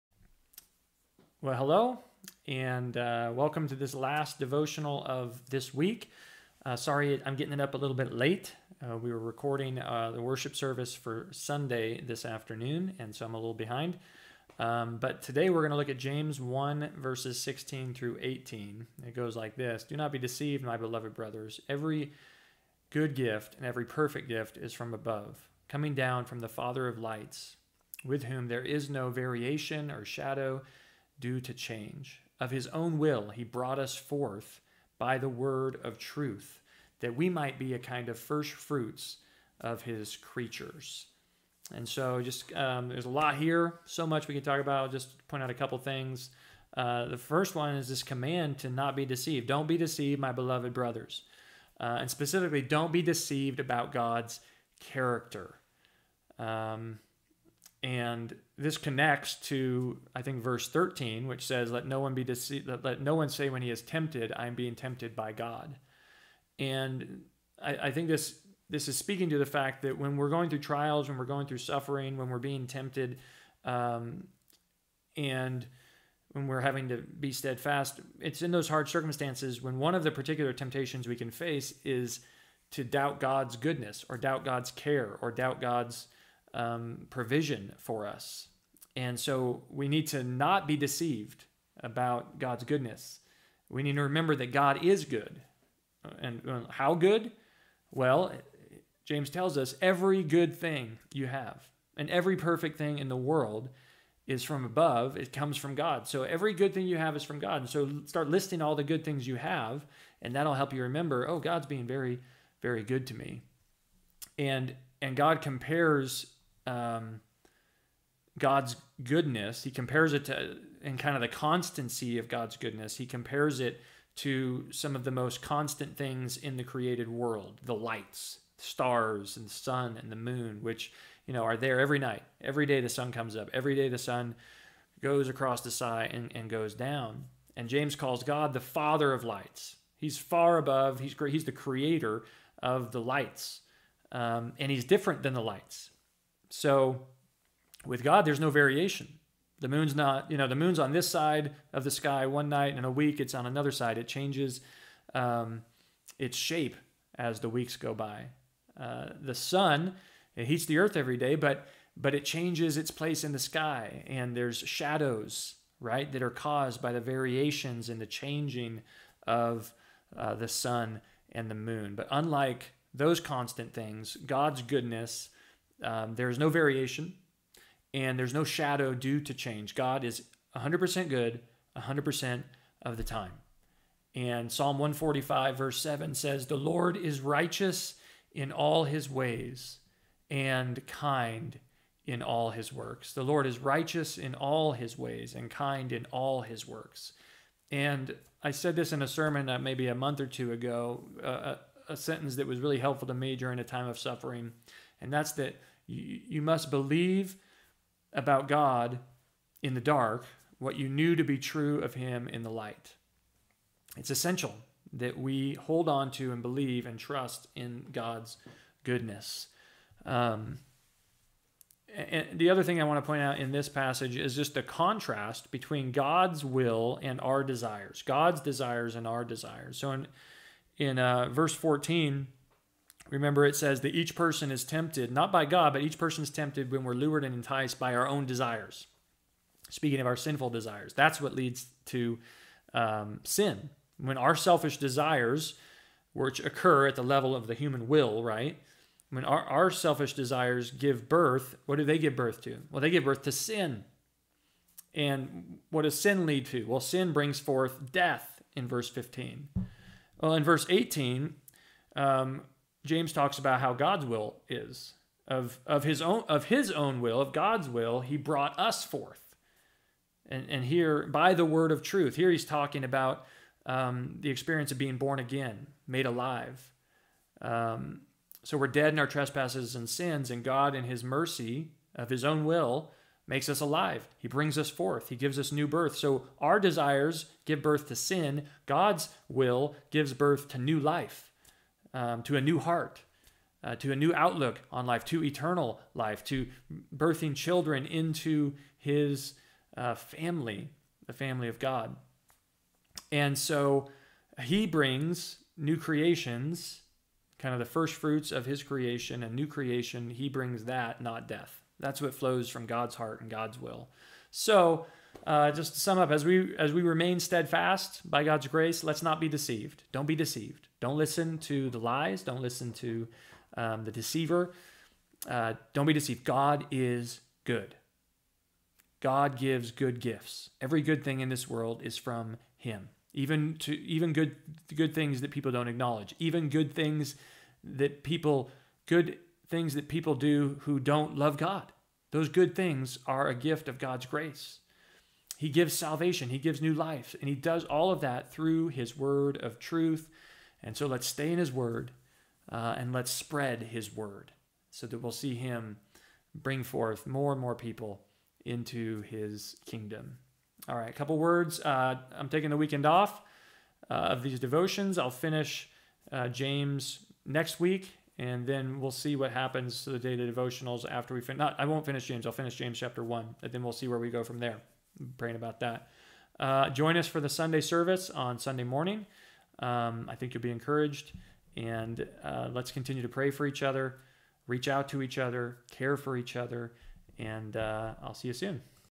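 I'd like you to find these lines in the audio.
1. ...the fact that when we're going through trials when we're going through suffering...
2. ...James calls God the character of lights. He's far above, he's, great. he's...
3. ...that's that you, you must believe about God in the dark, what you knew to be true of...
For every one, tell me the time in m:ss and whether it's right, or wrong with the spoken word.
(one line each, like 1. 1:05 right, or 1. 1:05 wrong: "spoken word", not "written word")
1. 1:09 right
2. 2:17 wrong: "father", not "character"
3. 3:25 right.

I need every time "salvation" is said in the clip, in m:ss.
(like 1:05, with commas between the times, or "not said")
5:45.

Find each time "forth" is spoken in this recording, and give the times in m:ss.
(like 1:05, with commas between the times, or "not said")
0:33, 4:17, 4:28, 4:44, 5:56.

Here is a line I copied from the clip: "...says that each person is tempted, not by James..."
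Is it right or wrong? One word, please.
wrong.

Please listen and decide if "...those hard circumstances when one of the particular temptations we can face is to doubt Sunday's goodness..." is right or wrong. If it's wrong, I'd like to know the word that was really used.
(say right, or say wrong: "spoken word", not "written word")
wrong: "God", not "Sunday".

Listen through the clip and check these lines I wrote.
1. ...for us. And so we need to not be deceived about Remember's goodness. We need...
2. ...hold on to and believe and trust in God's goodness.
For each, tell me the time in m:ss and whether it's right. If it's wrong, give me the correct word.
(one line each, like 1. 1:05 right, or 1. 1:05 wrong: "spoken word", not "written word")
1. 1:27 wrong: "God", not "Remember"
2. 3:35 right.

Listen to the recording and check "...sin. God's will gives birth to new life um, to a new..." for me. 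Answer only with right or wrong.
right.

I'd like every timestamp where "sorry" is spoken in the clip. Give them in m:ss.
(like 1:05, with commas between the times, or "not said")
0:06.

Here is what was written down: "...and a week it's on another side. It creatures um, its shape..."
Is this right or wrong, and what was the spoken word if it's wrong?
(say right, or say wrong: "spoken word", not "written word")
wrong: "changes", not "creatures".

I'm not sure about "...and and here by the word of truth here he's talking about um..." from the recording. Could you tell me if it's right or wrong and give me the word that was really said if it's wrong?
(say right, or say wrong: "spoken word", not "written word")
right.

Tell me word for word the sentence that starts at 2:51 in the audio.
But unlike those constant things, God's goodness, um, there is no variation and there's no shadow due to change.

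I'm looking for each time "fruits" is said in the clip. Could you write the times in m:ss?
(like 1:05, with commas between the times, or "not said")
0:38, 5:07.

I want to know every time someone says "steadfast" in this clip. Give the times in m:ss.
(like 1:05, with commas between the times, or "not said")
1:17, 5:17.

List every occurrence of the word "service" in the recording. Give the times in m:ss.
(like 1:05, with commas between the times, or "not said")
0:10, 6:17.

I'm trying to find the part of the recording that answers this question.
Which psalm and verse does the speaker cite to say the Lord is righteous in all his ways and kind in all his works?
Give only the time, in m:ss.
3:04.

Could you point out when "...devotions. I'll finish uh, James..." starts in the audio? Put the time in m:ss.
6:04.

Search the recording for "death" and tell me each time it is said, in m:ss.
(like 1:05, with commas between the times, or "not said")
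4:17, 5:11.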